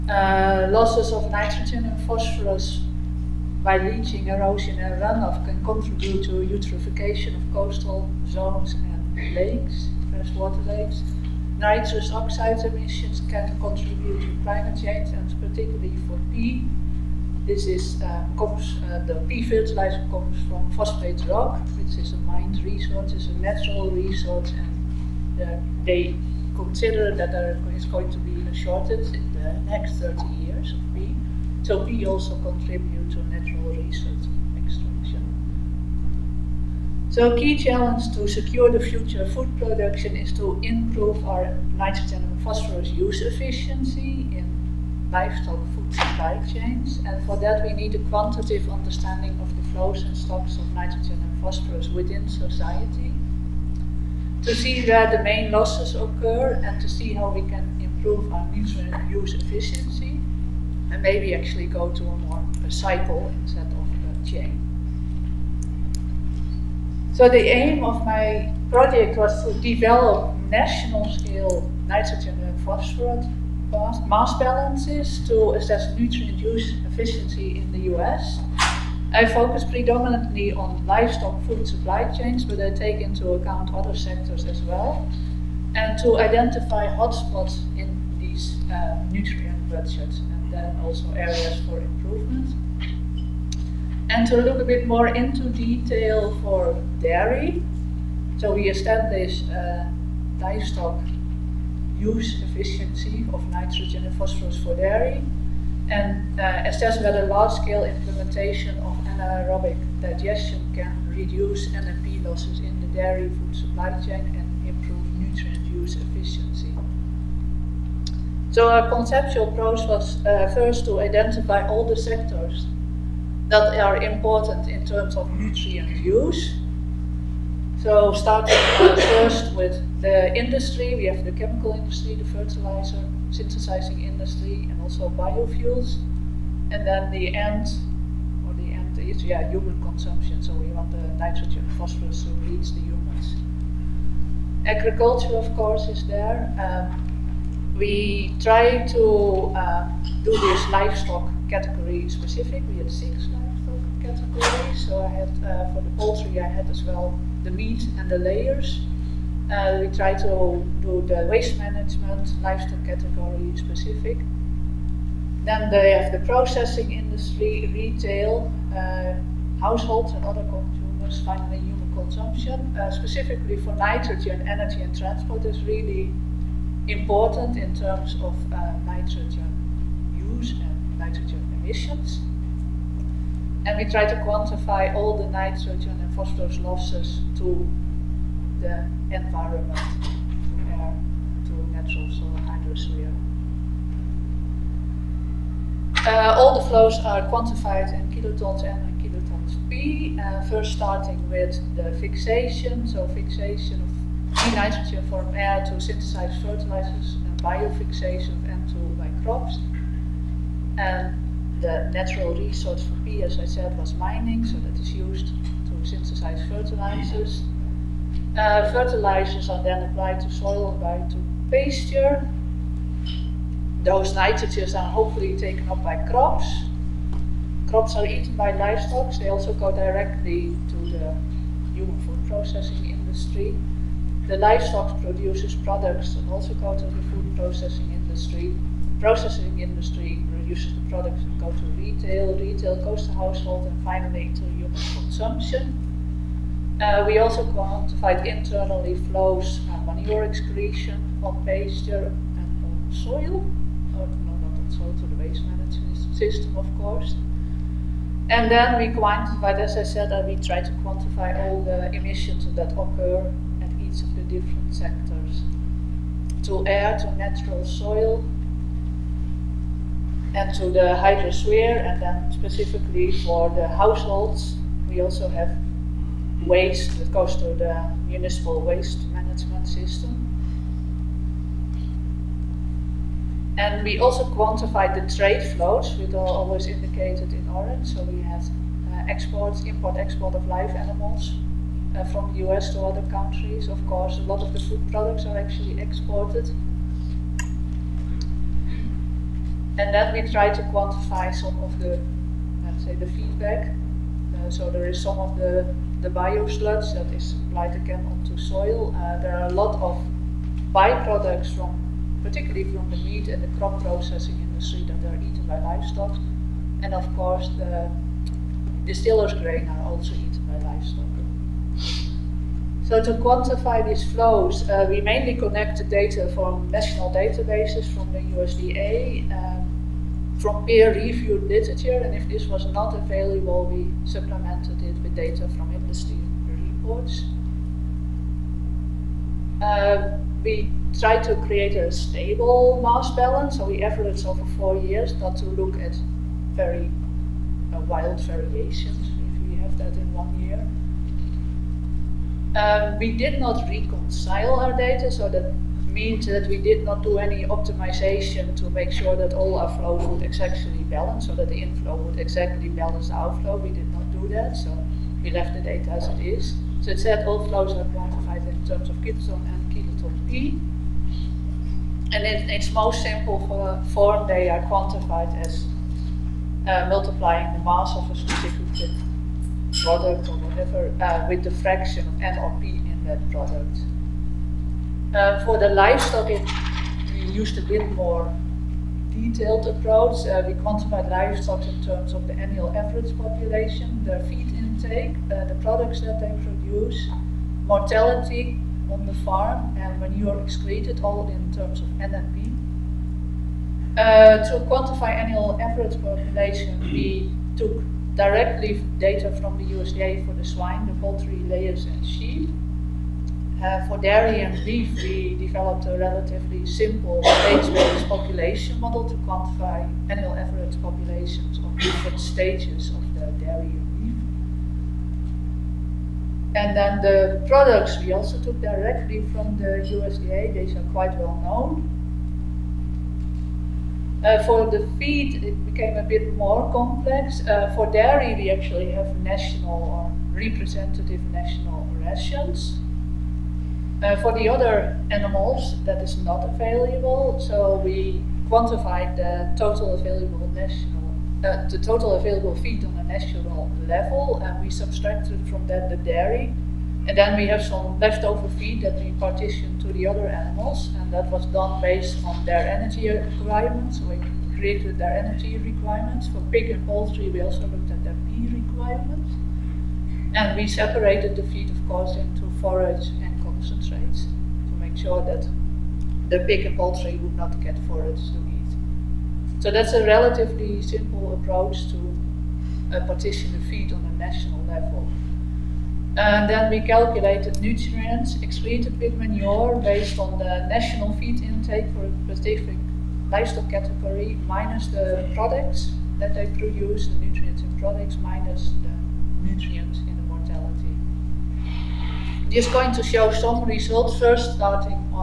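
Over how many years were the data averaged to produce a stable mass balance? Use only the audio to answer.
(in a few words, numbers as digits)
4.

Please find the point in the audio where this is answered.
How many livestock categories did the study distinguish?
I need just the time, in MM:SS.
02:32.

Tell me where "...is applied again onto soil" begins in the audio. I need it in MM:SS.
05:07.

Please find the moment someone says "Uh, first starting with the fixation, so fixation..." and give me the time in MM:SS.
03:20.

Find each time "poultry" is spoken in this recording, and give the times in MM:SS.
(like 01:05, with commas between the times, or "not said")
02:35, 06:50, 07:46, 07:56.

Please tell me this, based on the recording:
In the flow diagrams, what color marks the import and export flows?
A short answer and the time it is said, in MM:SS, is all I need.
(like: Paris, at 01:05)
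orange, at 04:47.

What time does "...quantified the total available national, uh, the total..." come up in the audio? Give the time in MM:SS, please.
07:28.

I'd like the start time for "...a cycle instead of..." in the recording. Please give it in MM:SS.
01:02.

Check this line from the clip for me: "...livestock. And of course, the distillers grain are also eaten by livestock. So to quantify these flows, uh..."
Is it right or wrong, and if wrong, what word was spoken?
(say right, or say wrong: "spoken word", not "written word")
right.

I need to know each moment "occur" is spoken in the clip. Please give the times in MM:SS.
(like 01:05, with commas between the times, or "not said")
00:55, 04:22.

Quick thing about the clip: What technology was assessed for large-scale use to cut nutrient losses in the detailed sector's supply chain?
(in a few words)
anaerobic digestion.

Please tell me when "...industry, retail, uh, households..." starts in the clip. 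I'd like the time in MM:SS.
02:46.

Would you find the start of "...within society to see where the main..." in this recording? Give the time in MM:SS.
00:51.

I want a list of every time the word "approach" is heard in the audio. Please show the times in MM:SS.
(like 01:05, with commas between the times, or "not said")
01:59, 06:29, 08:01.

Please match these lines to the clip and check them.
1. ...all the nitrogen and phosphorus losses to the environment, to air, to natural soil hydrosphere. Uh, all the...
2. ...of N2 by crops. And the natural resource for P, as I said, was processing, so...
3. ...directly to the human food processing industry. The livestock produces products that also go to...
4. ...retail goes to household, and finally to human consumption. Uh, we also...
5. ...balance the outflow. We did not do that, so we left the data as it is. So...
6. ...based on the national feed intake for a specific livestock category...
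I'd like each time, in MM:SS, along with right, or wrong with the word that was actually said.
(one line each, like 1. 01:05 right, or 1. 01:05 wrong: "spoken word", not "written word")
1. 03:04 right
2. 03:28 wrong: "mining", not "processing"
3. 03:49 right
4. 04:02 right
5. 06:02 right
6. 08:09 right.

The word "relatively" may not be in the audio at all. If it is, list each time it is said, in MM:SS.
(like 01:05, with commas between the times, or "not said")
06:55, 08:00.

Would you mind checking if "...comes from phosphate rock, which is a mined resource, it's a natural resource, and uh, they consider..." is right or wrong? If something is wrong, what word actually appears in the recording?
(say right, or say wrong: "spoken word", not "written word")
right.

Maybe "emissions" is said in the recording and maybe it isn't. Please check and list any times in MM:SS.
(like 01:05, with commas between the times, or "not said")
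00:12, 03:01, 04:21.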